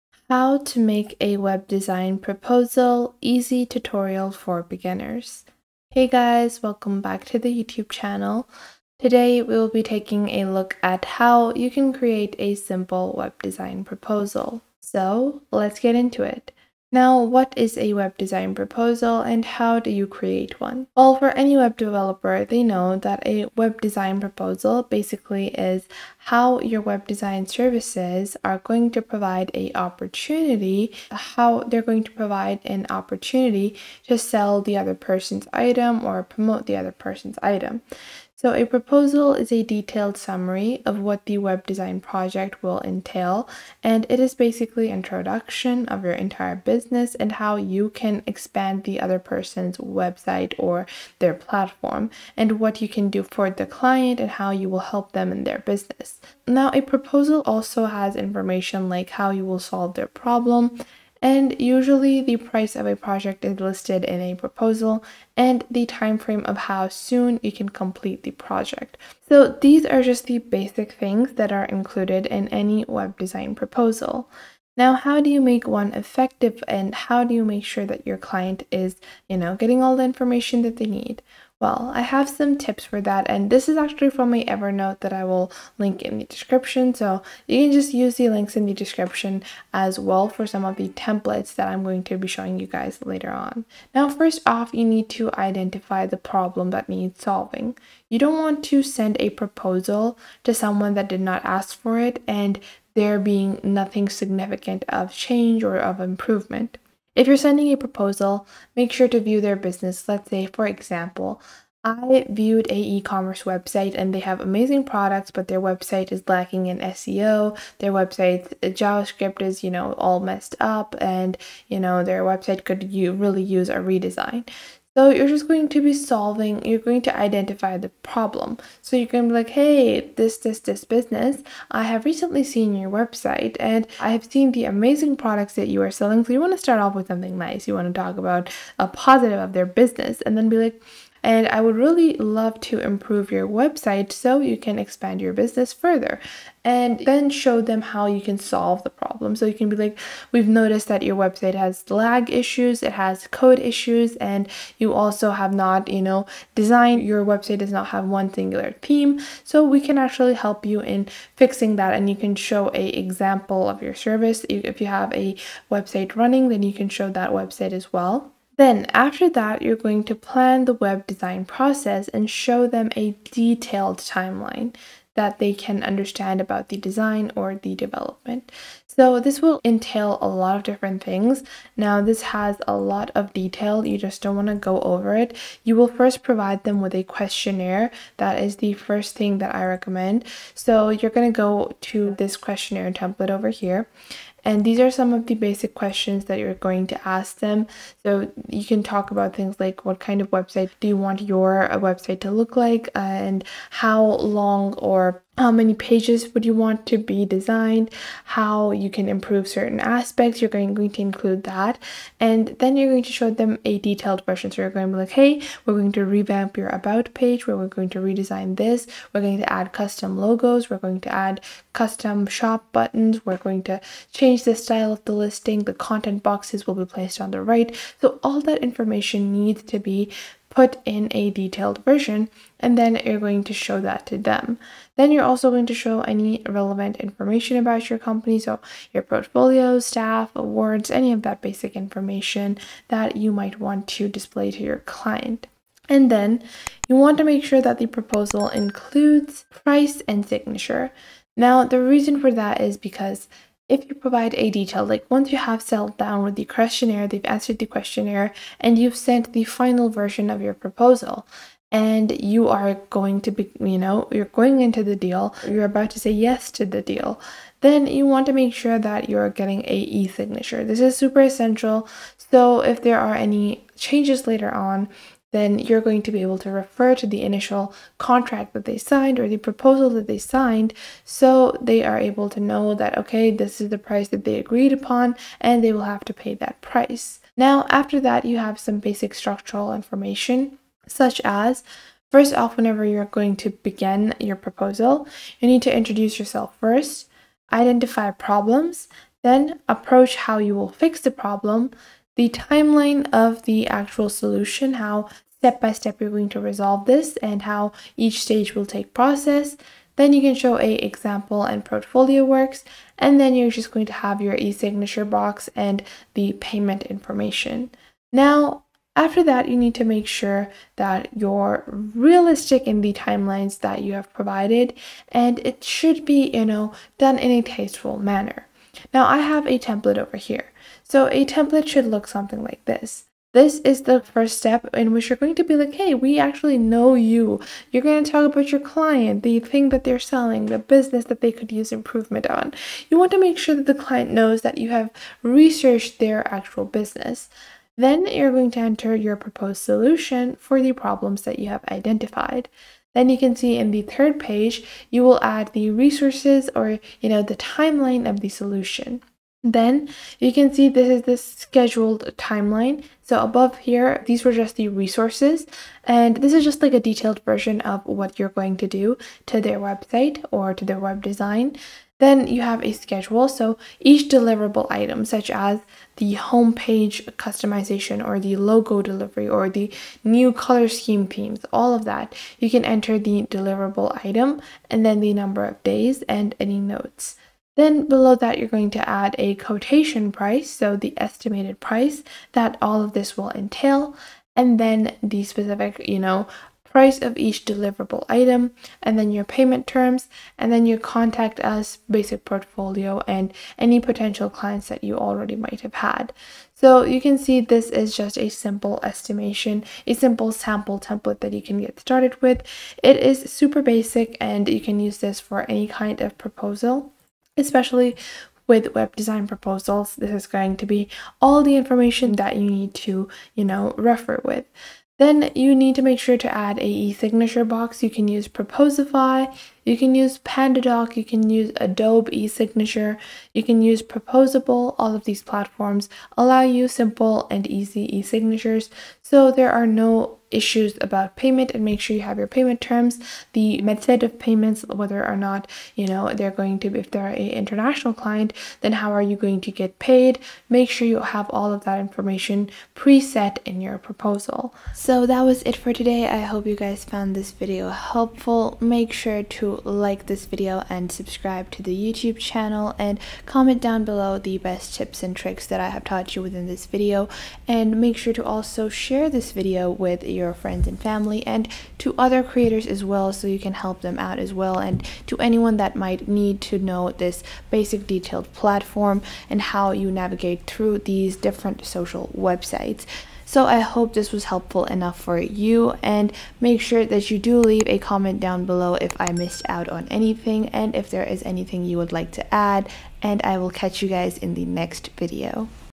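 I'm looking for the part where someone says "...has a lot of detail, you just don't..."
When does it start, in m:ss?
3:02.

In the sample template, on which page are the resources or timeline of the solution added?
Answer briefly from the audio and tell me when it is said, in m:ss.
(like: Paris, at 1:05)
Third page, at 5:53.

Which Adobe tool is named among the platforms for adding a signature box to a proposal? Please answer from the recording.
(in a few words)
Adobe e-signature.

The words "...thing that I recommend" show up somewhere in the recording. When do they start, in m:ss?
3:09.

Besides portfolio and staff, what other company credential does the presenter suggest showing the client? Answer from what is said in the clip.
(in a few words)
Awards.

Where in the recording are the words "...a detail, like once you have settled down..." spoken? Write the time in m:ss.
4:14.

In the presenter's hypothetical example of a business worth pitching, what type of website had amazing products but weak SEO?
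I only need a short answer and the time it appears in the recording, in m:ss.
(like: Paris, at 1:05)
e-commerce website, at 1:52.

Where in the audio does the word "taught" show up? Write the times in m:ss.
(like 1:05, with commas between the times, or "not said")
7:45.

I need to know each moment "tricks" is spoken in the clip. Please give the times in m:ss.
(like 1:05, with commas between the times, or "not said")
7:45.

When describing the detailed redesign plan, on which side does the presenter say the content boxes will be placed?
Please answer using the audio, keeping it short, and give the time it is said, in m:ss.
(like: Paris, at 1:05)
The right, at 3:47.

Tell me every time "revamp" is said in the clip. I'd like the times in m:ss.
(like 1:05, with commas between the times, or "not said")
3:36.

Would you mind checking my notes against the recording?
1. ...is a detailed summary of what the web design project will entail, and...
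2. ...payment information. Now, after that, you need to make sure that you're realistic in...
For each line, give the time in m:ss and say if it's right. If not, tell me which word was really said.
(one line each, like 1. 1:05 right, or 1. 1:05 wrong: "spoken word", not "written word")
1. 0:39 right
2. 5:16 right.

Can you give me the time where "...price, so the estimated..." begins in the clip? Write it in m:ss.
6:30.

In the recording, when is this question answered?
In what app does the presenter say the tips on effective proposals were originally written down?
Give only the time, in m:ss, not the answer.
1:24.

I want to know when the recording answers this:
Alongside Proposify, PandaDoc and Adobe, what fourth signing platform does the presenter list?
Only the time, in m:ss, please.
7:13.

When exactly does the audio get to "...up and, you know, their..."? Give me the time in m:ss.
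2:00.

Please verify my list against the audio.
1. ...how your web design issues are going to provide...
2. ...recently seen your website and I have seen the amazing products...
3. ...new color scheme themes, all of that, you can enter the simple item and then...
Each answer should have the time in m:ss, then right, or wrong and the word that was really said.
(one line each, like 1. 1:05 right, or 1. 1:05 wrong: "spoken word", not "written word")
1. 0:26 wrong: "services", not "issues"
2. 2:12 right
3. 6:20 wrong: "deliverable", not "simple".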